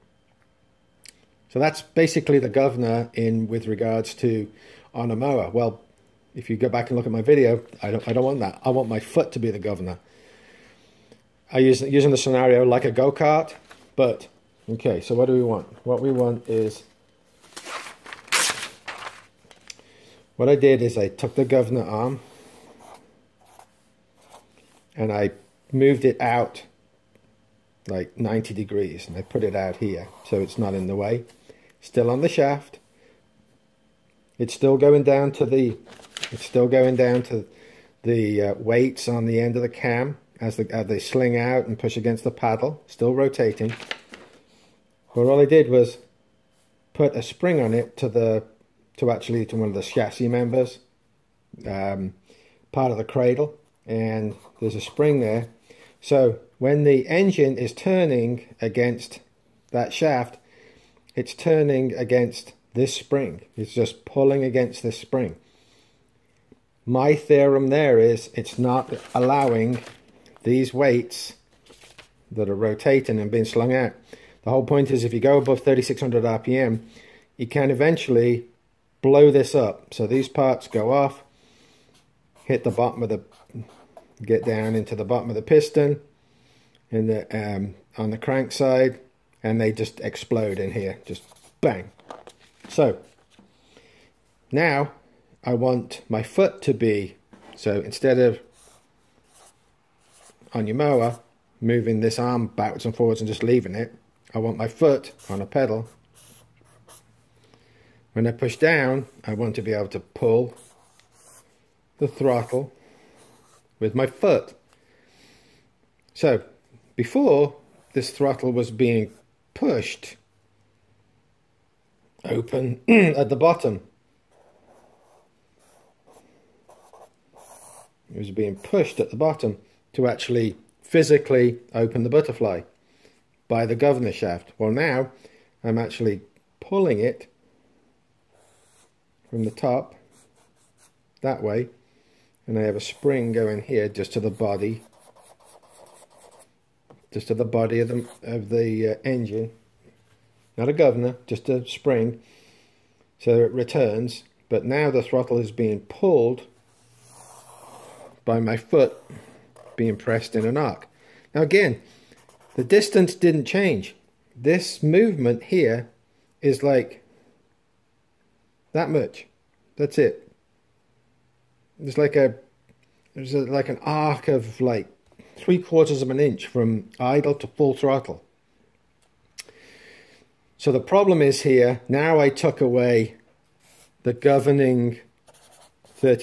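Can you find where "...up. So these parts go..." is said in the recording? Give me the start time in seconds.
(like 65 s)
79 s.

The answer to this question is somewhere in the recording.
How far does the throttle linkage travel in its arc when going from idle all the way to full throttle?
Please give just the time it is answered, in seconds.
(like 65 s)
175 s.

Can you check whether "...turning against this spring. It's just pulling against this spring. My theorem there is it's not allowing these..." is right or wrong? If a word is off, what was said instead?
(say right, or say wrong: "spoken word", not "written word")
right.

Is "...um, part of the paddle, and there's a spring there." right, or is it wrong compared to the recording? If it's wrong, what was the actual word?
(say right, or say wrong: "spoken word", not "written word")
wrong: "cradle", not "paddle".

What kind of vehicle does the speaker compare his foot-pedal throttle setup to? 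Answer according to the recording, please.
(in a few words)
go-kart.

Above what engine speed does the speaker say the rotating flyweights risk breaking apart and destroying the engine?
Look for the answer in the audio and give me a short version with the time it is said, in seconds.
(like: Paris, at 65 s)
3600 RPM, at 75 s.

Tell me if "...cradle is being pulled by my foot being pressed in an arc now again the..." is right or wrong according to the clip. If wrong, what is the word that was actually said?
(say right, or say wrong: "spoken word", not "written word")
wrong: "throttle", not "cradle".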